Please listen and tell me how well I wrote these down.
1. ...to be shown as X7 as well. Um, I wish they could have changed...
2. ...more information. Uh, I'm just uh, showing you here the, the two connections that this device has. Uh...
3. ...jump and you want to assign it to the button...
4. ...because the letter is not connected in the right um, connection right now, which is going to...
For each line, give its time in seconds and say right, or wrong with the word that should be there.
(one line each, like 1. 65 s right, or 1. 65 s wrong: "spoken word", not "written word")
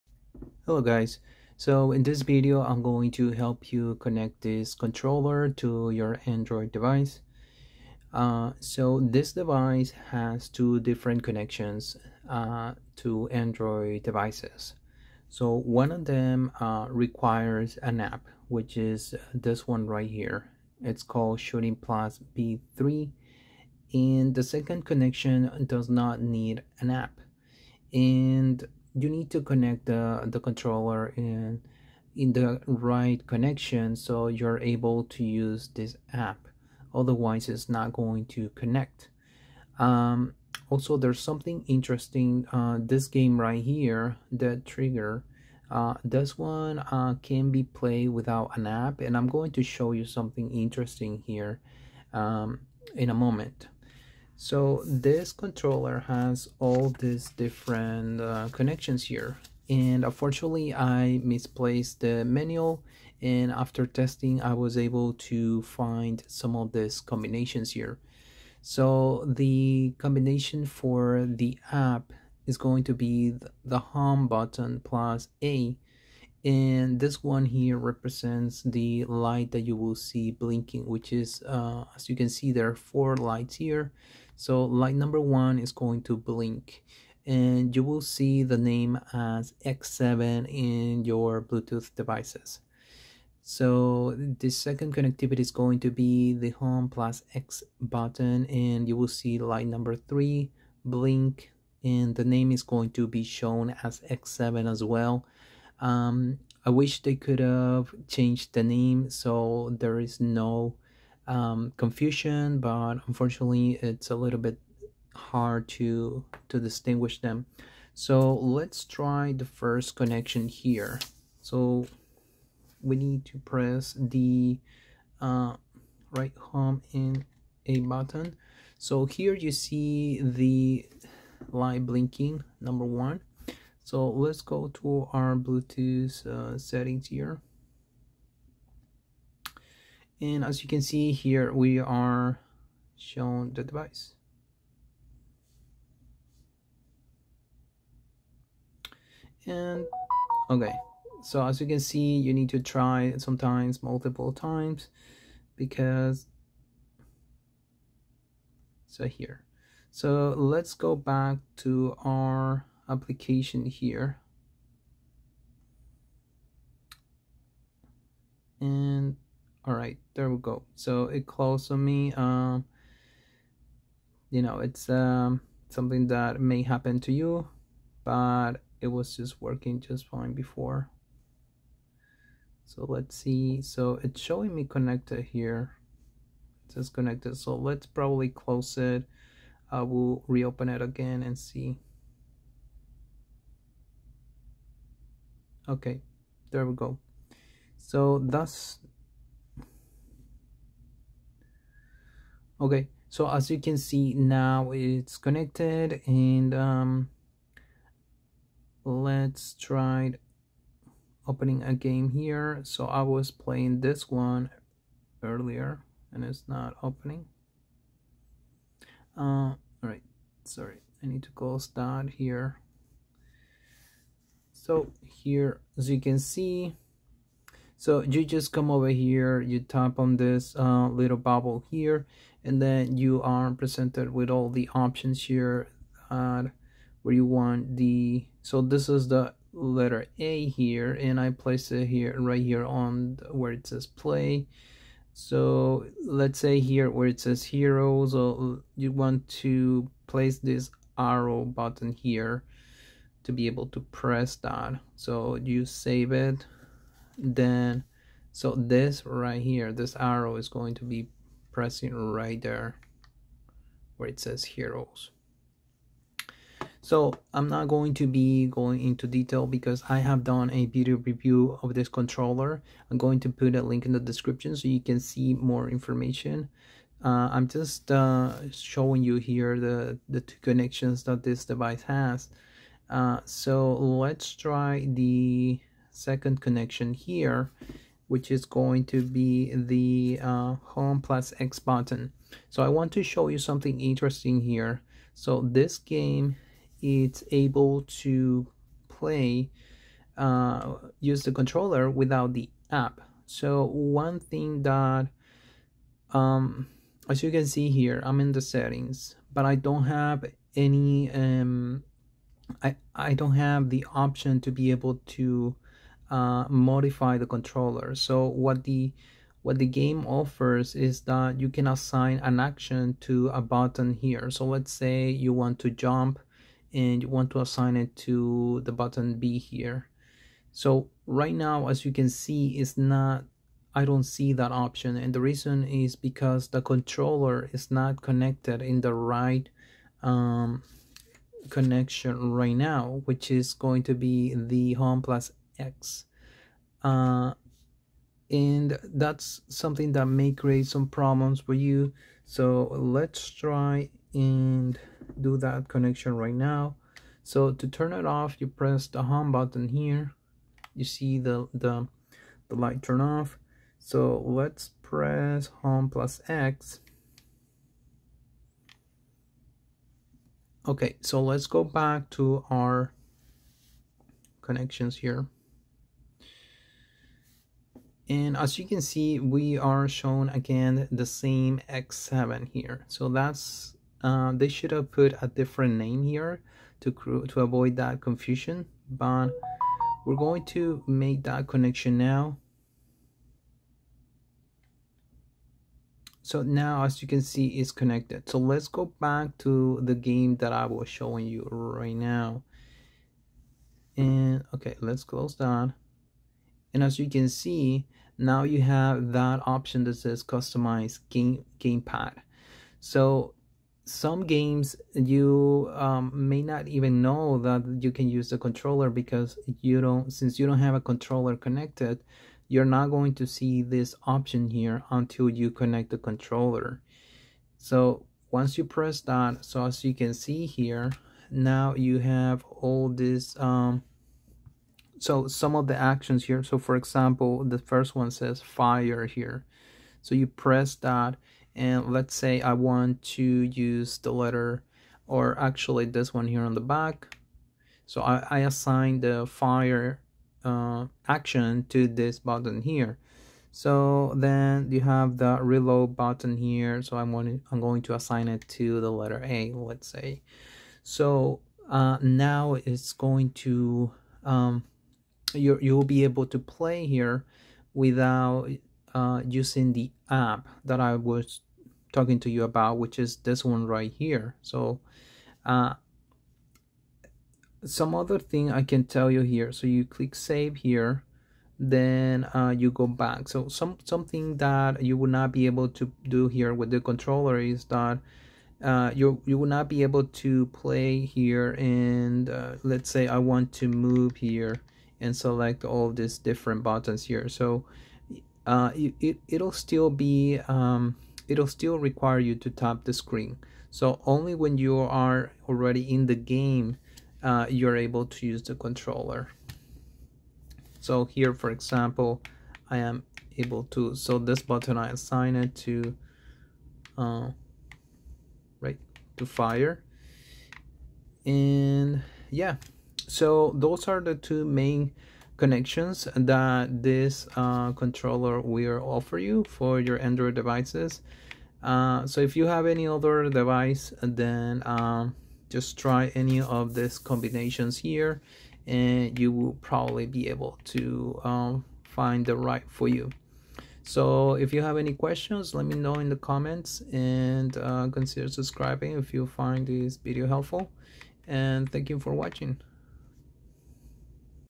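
1. 102 s right
2. 275 s right
3. 325 s right
4. 335 s wrong: "controller", not "letter".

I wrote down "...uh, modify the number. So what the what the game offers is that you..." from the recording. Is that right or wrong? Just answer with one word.
wrong.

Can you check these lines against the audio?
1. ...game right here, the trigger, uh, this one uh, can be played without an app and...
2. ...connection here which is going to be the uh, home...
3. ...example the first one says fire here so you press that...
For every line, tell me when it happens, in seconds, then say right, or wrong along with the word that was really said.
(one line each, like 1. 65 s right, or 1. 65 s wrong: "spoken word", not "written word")
1. 43 s right
2. 286 s right
3. 436 s right.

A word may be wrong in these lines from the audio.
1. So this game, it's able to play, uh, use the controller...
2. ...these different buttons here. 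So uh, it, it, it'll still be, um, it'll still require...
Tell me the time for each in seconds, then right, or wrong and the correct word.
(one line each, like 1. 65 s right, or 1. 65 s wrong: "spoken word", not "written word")
1. 295 s right
2. 495 s right.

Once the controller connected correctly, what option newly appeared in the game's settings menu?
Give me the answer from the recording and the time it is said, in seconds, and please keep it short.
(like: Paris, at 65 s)
Customize game gamepad, at 410 s.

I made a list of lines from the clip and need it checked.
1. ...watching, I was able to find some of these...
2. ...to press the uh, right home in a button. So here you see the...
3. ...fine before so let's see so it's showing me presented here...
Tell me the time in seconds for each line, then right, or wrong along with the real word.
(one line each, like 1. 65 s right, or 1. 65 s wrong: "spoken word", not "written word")
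1. 63 s wrong: "testing", not "watching"
2. 123 s right
3. 180 s wrong: "connected", not "presented".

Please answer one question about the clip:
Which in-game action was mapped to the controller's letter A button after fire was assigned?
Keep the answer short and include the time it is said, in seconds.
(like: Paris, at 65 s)
Reload, at 455 s.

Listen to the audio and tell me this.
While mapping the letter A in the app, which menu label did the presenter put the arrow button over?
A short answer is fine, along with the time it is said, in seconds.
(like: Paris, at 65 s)
Heroes, at 264 s.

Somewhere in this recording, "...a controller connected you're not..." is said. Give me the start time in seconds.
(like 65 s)
420 s.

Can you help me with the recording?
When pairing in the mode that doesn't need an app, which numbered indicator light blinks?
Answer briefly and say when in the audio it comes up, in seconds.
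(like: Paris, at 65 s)
Light number three, at 99 s.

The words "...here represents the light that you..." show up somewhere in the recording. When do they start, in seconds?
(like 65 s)
77 s.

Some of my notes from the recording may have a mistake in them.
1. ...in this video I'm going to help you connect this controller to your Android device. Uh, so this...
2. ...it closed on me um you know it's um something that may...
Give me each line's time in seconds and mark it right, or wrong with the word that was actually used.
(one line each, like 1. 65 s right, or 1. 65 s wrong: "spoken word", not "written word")
1. 1 s right
2. 171 s right.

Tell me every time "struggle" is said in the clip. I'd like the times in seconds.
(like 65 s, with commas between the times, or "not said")
not said.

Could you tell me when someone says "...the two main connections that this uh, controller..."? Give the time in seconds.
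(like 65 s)
524 s.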